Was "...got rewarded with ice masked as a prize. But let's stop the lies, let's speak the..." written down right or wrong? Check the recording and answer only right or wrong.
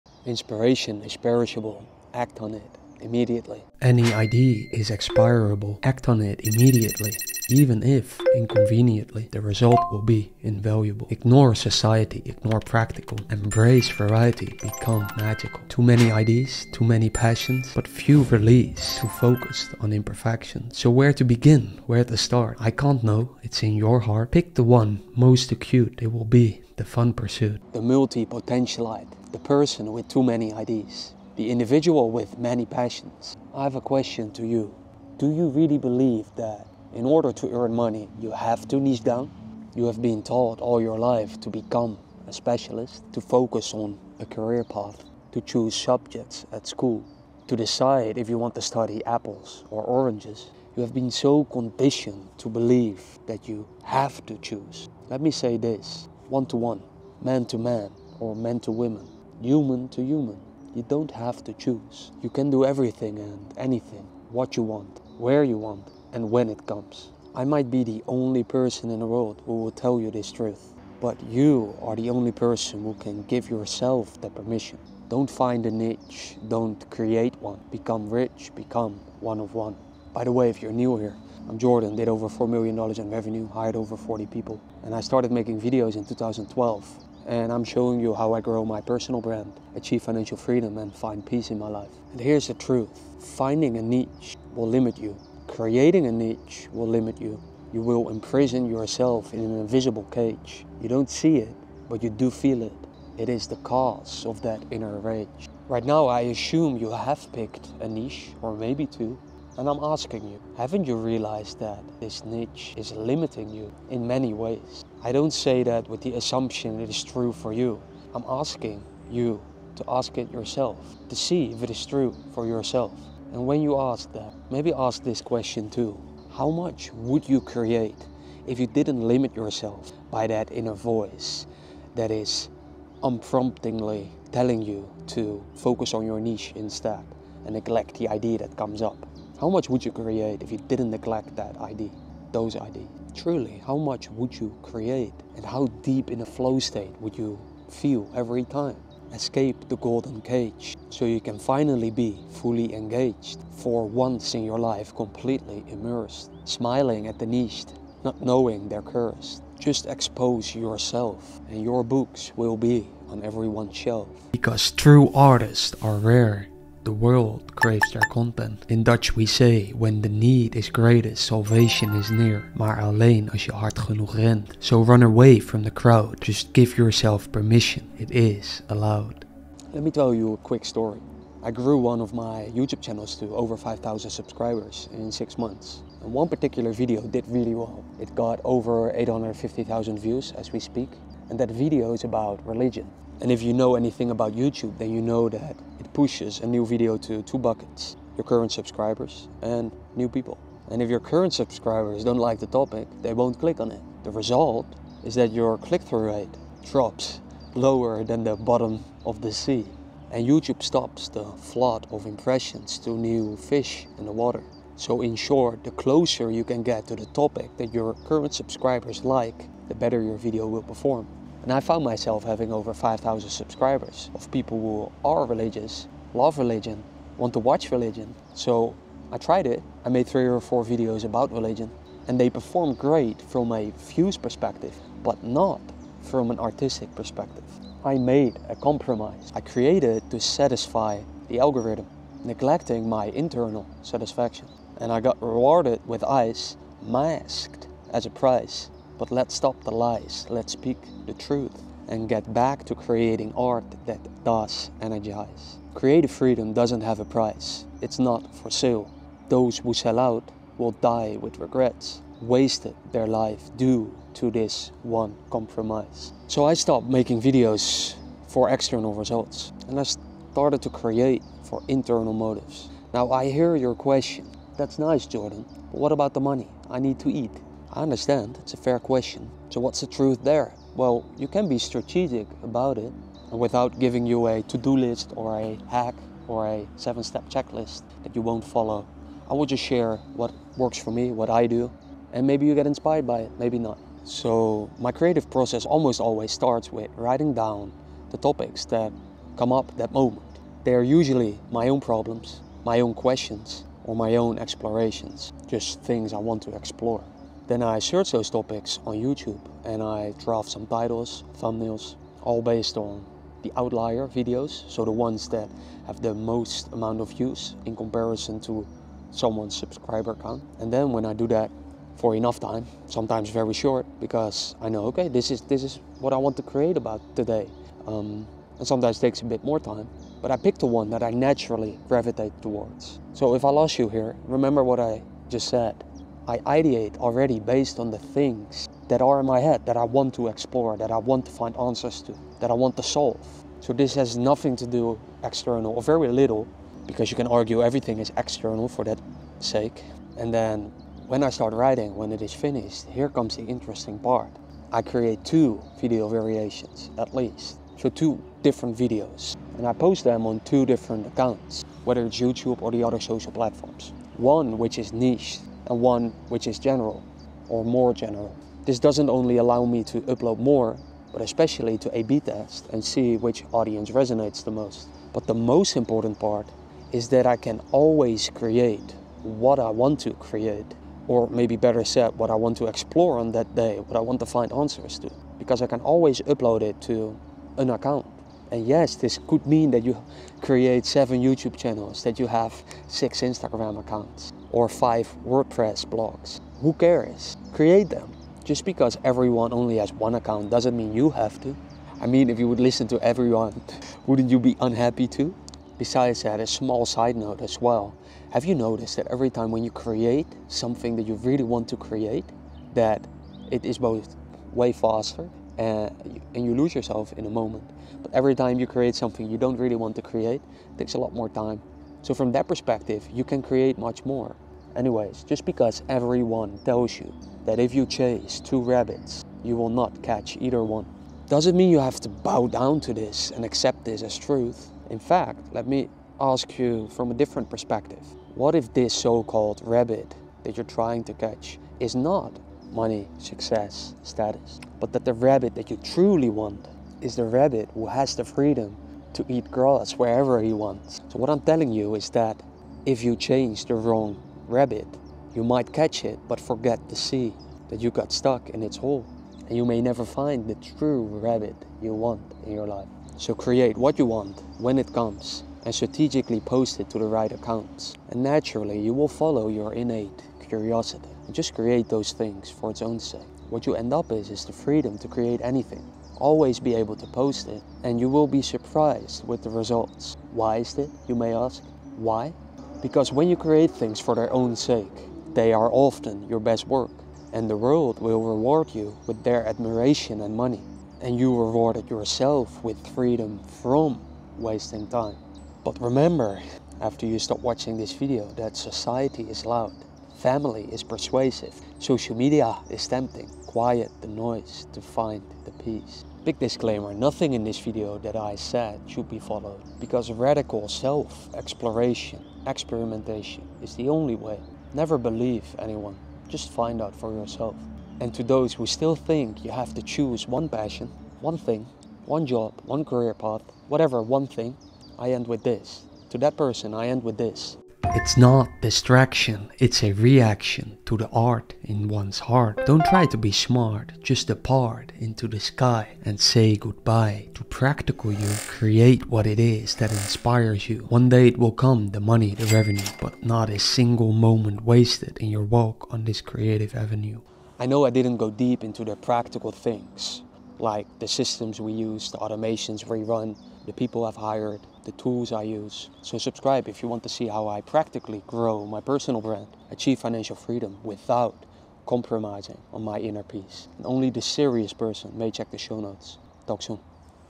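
right.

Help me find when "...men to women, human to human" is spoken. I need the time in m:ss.
0:58.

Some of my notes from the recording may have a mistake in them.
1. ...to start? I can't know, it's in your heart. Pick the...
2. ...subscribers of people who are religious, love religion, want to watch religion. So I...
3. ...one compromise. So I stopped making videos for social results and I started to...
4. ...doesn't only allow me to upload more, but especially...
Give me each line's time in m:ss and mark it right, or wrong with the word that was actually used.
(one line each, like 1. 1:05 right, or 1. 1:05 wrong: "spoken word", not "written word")
1. 0:22 right
2. 3:43 right
3. 4:24 wrong: "external", not "social"
4. 6:08 right.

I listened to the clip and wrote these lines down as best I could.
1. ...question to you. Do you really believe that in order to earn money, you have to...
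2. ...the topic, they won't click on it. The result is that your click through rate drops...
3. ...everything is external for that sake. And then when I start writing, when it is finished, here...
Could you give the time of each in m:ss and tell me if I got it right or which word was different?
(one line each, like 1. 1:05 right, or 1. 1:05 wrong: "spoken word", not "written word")
1. 0:33 right
2. 3:22 right
3. 5:47 right.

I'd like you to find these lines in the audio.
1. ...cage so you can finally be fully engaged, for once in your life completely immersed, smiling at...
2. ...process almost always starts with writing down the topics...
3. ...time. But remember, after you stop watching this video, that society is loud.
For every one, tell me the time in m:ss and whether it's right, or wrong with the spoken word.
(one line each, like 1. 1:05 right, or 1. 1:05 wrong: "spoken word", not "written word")
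1. 2:30 right
2. 4:55 right
3. 8:14 right.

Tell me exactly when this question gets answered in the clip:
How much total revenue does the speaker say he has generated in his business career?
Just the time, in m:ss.
1:22.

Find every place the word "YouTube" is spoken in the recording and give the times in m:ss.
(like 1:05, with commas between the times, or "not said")
3:02, 3:14, 3:30, 5:09, 6:02, 6:31.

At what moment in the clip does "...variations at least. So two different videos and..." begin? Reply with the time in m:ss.
5:56.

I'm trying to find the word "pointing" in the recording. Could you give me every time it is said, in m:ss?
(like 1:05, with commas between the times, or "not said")
not said.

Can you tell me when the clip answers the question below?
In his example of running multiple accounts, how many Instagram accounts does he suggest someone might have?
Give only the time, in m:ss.
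6:32.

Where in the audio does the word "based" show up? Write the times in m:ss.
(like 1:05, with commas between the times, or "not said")
5:12, 5:37.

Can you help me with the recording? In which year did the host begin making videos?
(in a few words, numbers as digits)
2012.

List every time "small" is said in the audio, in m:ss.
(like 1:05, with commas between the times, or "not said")
6:46.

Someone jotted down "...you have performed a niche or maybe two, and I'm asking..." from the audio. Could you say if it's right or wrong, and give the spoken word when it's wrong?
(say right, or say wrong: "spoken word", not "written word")
wrong: "picked", not "performed".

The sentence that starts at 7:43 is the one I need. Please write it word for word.
So create what you want when it comes and strategically post it to the right accounts.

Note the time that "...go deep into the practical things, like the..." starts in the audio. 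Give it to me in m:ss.
9:08.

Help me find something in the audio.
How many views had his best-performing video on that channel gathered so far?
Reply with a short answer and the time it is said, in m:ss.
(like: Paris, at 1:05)
850,000, at 3:08.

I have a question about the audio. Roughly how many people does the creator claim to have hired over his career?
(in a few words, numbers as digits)
over 40.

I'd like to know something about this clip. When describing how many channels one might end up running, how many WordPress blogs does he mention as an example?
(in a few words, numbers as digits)
5.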